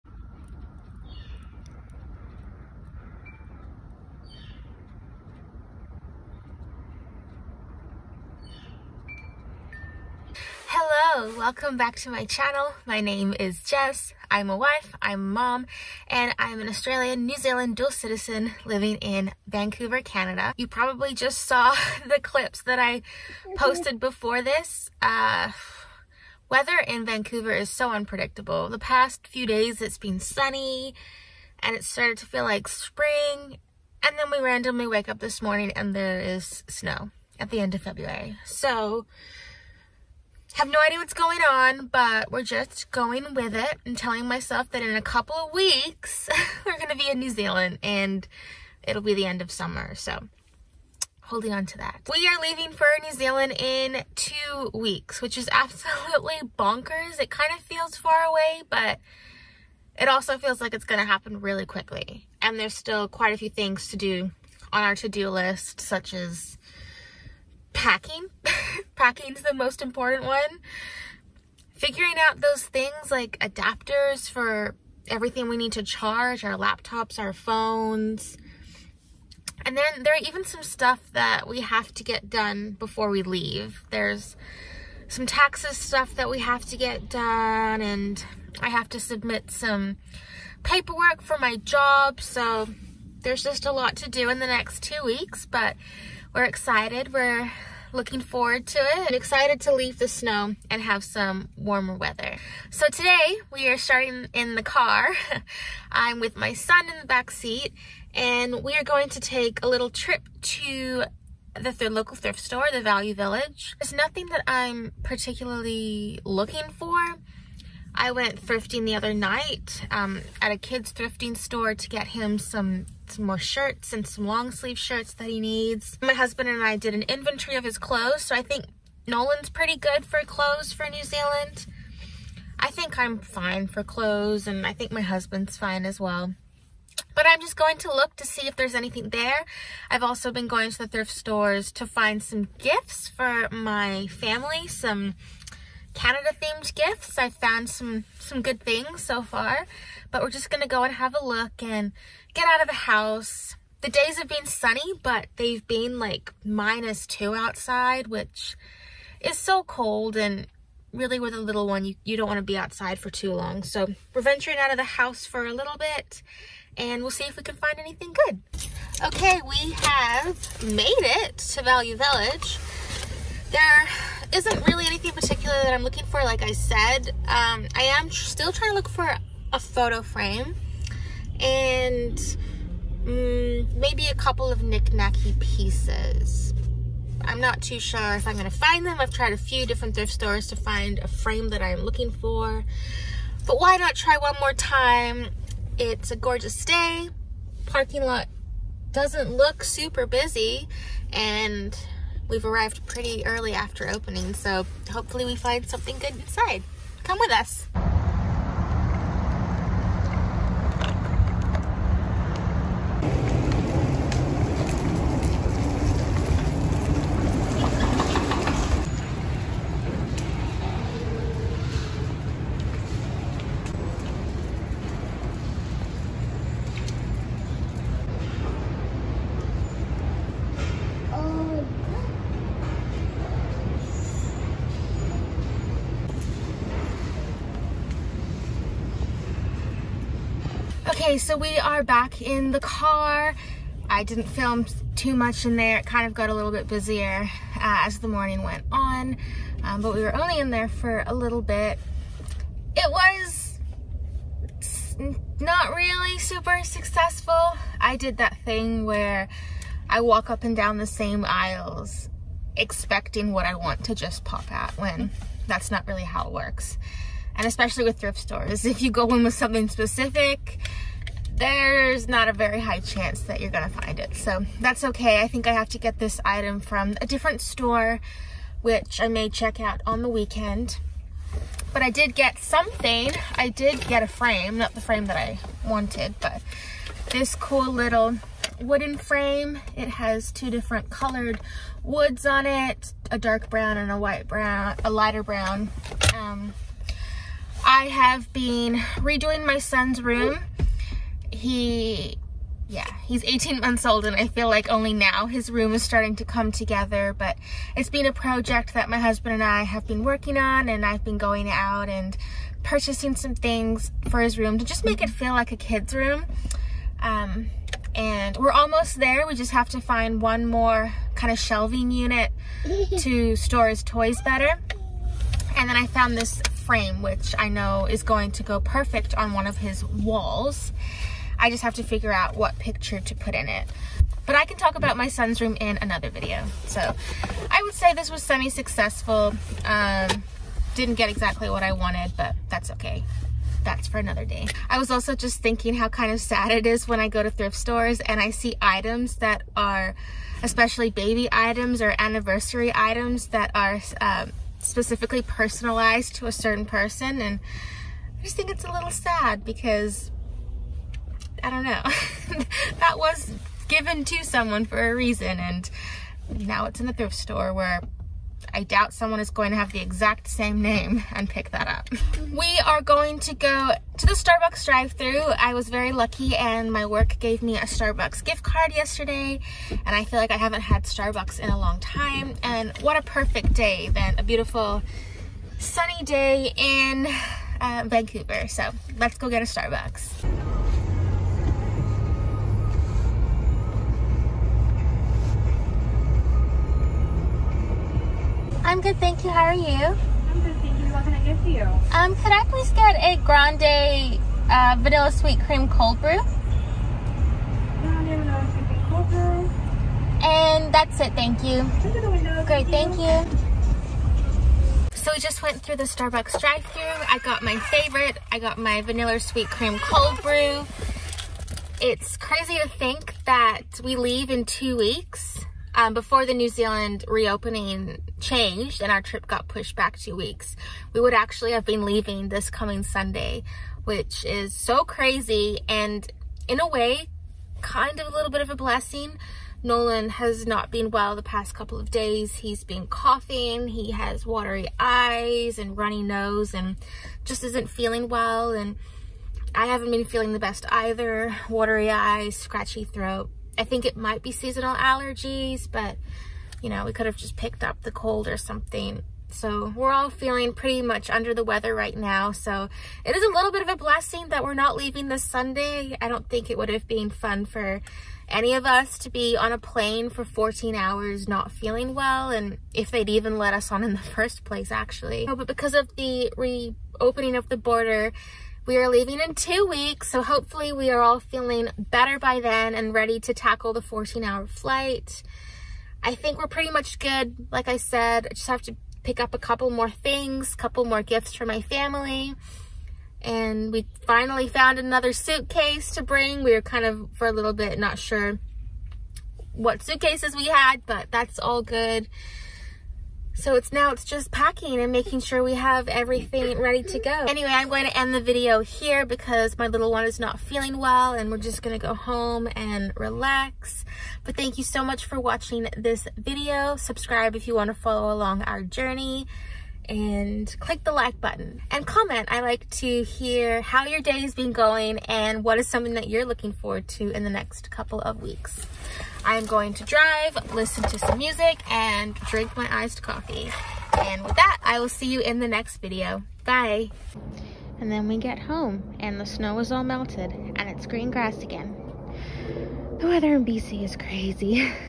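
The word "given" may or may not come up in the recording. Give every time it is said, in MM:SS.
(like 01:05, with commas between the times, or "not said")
06:03.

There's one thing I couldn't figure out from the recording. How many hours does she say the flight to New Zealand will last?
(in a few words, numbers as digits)
14.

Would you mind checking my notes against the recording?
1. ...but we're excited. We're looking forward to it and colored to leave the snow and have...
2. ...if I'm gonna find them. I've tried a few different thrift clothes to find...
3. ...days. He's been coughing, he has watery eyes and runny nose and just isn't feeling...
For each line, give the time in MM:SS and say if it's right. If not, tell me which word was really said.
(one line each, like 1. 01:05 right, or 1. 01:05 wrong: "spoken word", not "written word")
1. 01:35 wrong: "excited", not "colored"
2. 03:08 wrong: "stores", not "clothes"
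3. 07:21 right.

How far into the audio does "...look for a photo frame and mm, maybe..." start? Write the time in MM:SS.
02:58.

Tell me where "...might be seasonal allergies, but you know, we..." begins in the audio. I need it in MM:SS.
07:33.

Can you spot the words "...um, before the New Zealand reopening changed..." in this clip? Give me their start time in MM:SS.
07:05.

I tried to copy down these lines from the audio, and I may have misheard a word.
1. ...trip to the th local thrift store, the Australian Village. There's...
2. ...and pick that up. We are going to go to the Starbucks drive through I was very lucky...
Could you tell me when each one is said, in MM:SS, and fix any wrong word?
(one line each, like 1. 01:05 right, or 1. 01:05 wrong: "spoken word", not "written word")
1. 01:49 wrong: "Value", not "Australian"
2. 06:11 right.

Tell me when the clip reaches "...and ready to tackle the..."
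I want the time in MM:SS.
08:02.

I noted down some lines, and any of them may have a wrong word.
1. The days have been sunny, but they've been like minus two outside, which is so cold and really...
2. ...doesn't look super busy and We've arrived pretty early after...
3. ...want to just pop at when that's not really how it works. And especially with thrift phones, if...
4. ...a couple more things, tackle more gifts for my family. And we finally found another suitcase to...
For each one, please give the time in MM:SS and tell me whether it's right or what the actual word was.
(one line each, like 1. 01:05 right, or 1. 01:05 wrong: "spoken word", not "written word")
1. 02:33 right
2. 03:18 right
3. 04:23 wrong: "stores", not "phones"
4. 08:09 wrong: "couple", not "tackle".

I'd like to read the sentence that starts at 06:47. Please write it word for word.
Grande vanilla sweet cream cold brew.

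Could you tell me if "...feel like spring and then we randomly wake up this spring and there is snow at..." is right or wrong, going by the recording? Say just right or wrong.
wrong.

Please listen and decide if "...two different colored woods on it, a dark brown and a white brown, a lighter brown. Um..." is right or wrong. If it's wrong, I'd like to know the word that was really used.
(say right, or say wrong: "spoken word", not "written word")
right.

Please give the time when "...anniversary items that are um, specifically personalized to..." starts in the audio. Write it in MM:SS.
05:51.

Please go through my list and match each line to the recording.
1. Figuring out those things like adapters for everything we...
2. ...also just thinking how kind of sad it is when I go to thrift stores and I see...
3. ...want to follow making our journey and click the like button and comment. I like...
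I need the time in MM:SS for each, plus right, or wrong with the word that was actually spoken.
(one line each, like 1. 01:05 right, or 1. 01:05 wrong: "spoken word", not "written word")
1. 01:11 right
2. 05:44 right
3. 08:37 wrong: "along", not "making".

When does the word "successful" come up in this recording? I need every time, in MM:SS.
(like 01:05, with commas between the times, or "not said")
04:16, 05:38.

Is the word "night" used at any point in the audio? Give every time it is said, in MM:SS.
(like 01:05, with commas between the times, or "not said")
01:59.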